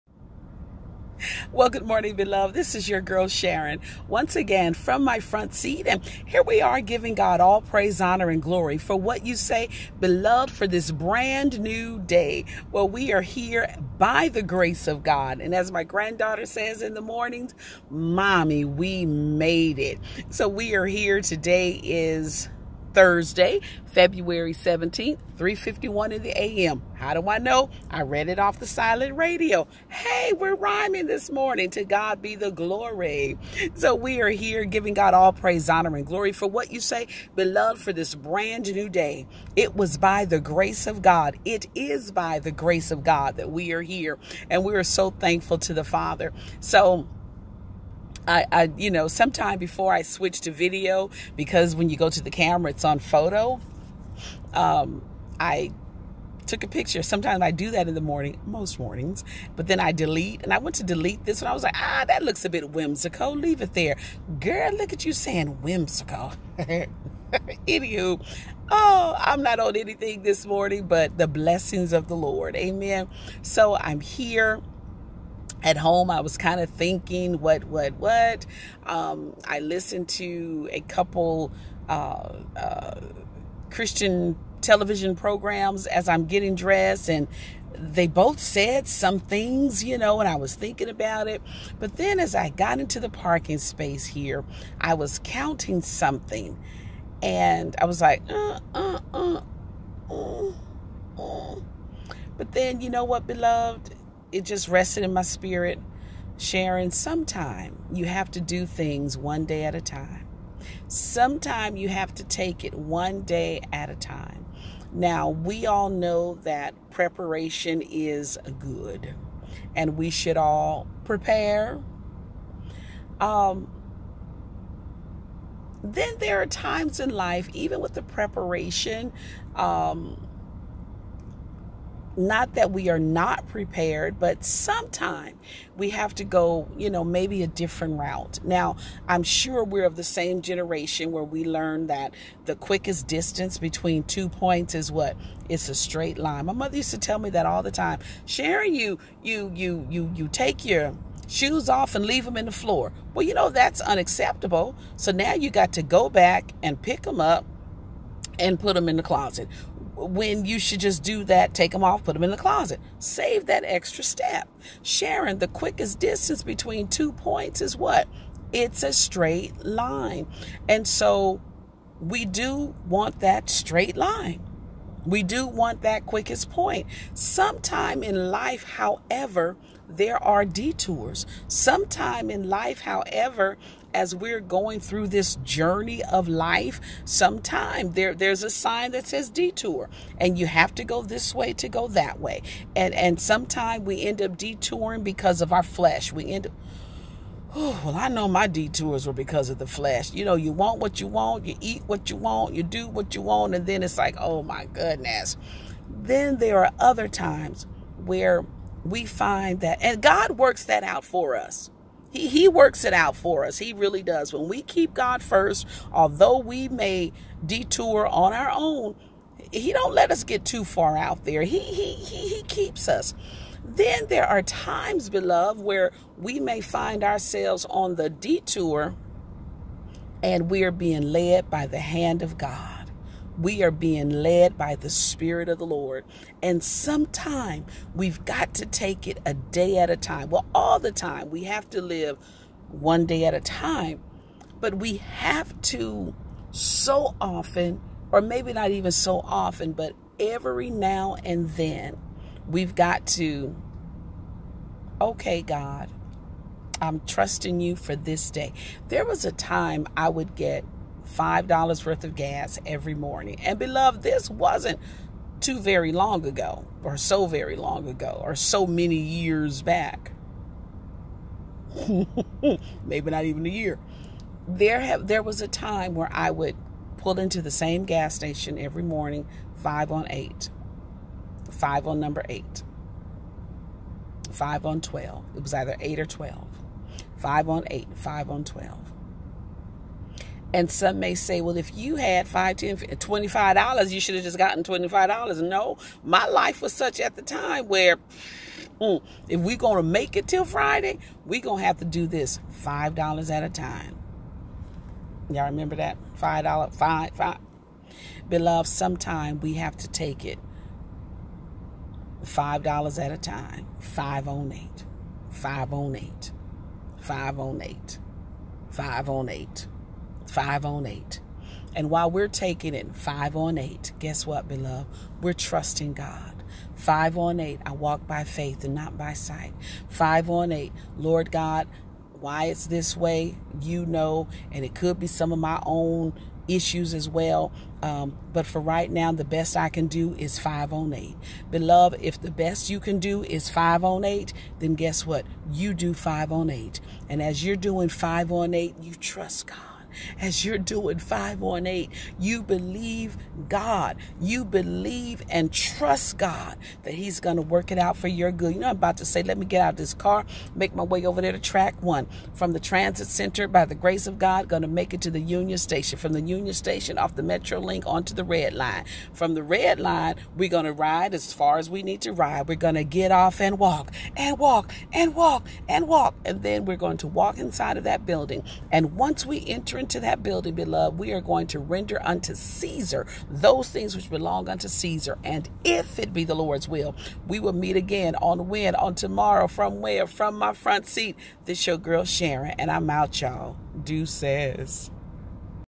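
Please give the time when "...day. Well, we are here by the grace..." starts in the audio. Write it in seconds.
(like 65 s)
11 s.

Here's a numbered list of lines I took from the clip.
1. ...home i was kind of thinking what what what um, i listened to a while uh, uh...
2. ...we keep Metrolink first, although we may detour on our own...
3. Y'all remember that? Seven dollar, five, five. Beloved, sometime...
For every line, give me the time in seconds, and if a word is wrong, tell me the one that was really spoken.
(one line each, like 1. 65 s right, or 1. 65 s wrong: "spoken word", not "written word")
1. 75 s wrong: "couple", not "while"
2. 214 s wrong: "God", not "Metrolink"
3. 305 s wrong: "Five", not "Seven".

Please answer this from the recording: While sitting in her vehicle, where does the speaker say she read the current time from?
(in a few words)
the silent radio.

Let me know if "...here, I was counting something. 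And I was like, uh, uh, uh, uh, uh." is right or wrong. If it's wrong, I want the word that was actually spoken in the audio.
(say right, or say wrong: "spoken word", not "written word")
right.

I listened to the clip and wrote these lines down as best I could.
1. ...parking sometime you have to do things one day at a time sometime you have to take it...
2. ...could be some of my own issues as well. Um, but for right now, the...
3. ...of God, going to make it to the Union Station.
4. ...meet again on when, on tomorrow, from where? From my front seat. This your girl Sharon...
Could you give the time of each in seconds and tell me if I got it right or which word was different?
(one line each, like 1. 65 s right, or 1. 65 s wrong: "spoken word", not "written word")
1. 106 s wrong: "sharing", not "parking"
2. 334 s right
3. 364 s right
4. 387 s right.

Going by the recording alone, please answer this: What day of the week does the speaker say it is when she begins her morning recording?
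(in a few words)
Thursday.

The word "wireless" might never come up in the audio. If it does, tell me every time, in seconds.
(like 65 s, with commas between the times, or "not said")
not said.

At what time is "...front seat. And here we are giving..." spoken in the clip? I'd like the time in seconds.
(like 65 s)
5 s.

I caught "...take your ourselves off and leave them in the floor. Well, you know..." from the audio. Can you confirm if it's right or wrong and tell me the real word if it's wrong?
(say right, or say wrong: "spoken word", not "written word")
wrong: "shoes", not "ourselves".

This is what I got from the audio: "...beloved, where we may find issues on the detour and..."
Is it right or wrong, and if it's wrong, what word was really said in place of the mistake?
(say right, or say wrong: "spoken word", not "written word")
wrong: "ourselves", not "issues".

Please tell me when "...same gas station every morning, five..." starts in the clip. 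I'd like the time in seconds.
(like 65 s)
277 s.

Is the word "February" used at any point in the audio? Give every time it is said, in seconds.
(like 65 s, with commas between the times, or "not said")
23 s.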